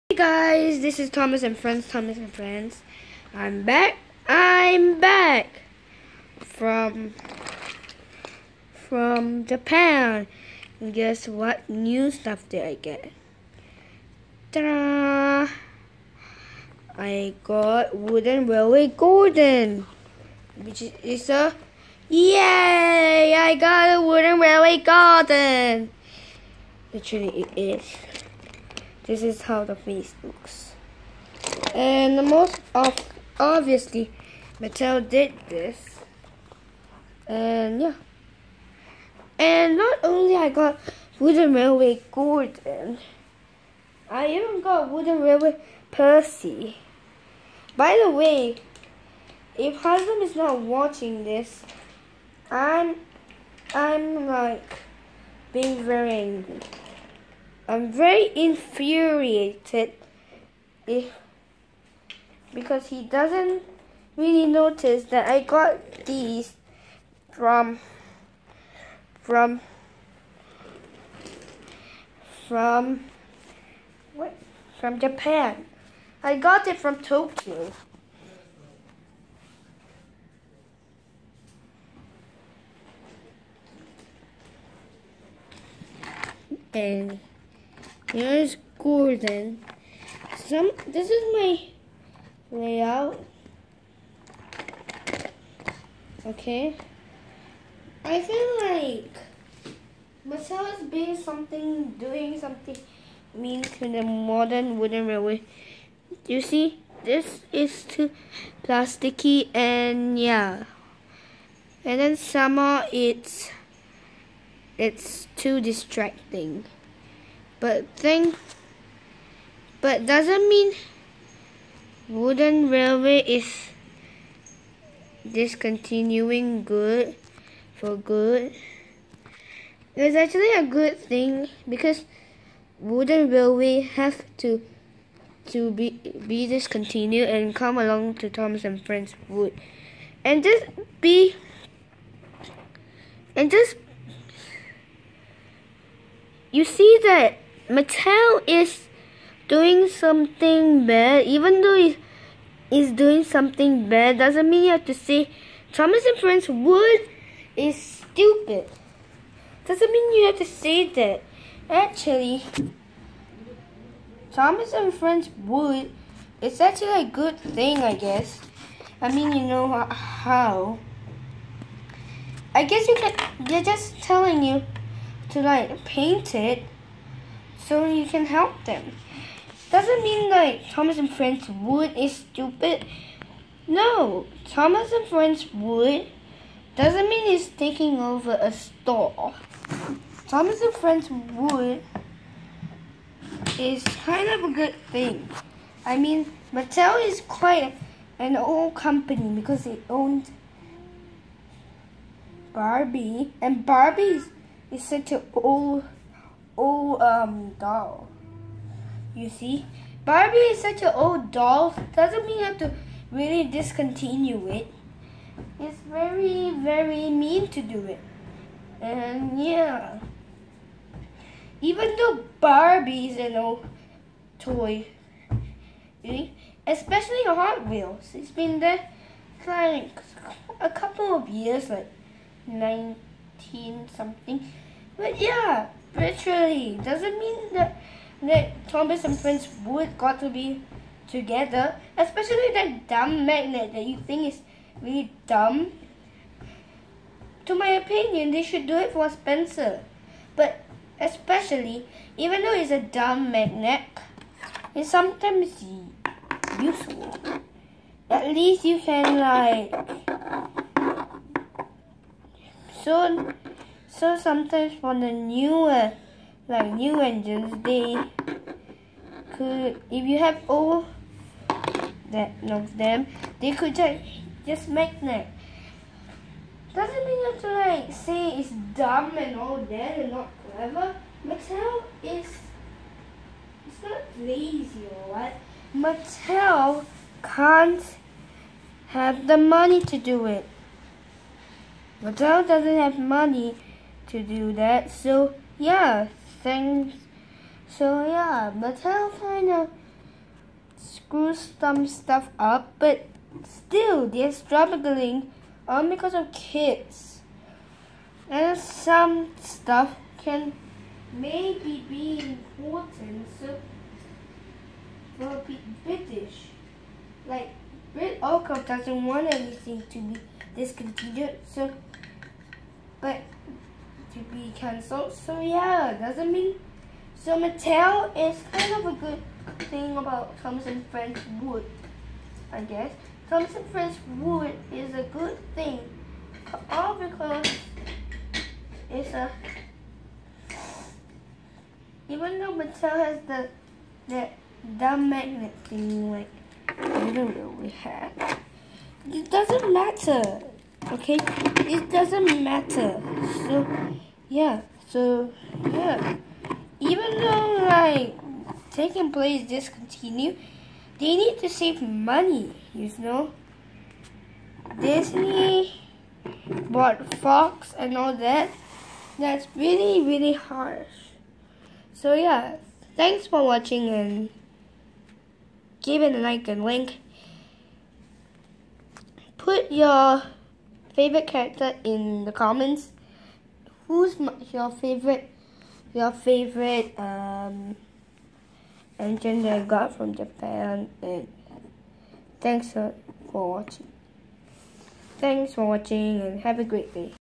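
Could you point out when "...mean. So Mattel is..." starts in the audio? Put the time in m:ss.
5:26.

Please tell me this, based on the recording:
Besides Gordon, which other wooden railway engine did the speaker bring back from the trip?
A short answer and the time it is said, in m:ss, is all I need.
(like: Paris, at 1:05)
Percy, at 0:44.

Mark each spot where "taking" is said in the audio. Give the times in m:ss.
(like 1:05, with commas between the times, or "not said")
3:07, 5:58.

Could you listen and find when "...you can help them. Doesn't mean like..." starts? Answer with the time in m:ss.
2:57.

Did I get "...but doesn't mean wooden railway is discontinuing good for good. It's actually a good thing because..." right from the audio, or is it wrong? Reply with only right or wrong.
right.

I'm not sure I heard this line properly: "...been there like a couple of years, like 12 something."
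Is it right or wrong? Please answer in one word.
wrong.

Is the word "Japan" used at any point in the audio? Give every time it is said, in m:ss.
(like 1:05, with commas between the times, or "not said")
0:09, 1:14, 6:30.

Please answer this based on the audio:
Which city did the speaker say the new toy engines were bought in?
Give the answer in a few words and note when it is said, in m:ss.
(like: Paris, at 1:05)
Tokyo, at 1:17.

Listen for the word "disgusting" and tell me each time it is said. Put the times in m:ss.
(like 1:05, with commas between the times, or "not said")
not said.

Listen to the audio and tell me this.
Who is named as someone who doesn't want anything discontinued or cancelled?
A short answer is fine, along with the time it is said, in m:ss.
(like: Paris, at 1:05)
Britt Allcroft, at 5:17.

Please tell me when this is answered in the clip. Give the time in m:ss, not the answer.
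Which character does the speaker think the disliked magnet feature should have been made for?
4:09.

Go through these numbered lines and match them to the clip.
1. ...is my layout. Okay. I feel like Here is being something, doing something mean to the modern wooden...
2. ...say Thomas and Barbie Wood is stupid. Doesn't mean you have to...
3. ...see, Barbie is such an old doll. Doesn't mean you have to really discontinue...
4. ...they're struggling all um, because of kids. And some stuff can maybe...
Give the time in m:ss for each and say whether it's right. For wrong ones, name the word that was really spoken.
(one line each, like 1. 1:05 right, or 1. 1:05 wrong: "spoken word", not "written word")
1. 1:31 wrong: "Mattel", not "Here"
2. 2:34 wrong: "Friends", not "Barbie"
3. 3:29 right
4. 5:04 right.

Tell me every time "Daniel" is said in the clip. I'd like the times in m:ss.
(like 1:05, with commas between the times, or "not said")
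not said.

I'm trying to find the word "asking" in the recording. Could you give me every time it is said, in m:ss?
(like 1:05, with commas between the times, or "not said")
not said.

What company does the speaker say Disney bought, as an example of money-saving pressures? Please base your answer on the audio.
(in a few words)
Fox.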